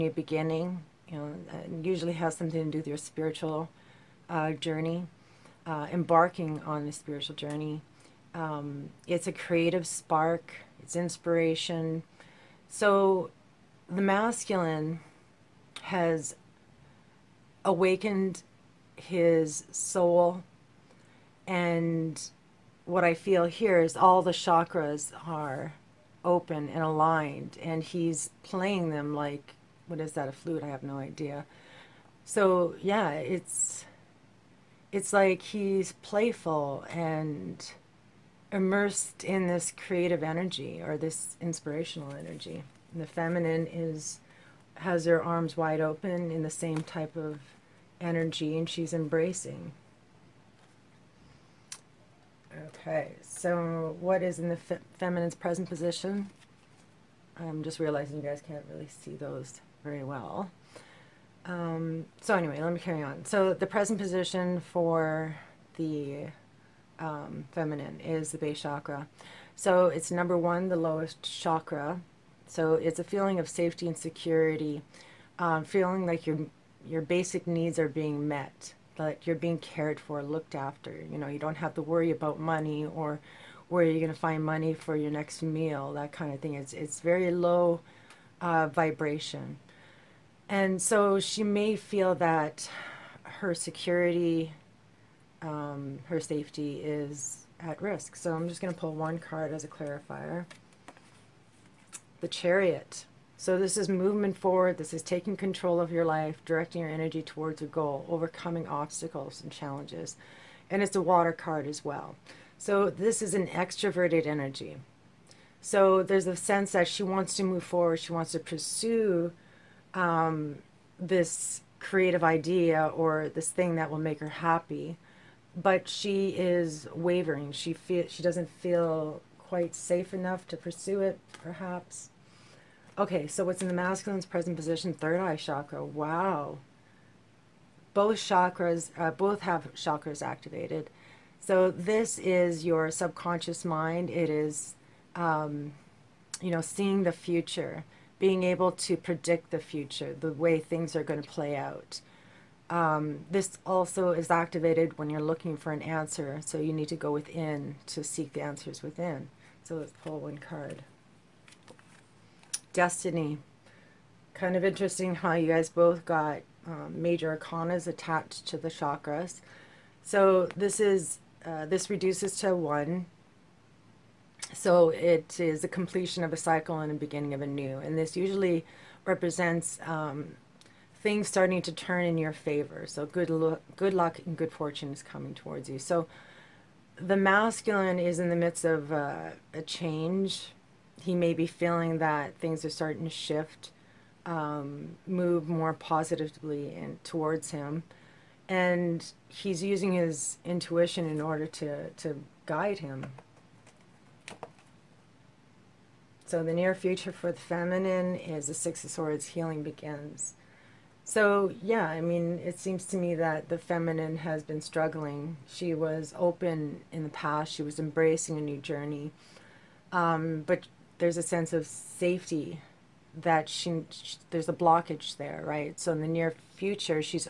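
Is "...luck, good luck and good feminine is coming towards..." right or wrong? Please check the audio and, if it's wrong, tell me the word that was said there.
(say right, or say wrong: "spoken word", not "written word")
wrong: "fortune", not "feminine".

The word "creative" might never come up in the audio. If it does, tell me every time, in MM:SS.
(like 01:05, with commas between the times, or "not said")
00:09, 00:39, 02:01.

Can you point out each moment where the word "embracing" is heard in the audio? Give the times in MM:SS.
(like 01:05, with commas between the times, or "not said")
00:48, 03:37.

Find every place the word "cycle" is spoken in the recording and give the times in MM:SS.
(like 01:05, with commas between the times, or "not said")
02:56.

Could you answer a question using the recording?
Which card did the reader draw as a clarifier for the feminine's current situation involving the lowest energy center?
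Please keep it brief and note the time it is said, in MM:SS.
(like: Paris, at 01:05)
The Chariot, at 01:42.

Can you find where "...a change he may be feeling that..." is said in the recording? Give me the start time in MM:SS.
03:09.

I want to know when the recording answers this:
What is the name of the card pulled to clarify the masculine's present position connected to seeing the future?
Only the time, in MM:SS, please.
02:42.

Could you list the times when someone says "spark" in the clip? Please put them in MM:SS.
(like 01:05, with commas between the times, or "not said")
00:09.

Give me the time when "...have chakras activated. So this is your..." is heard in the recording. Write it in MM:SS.
02:19.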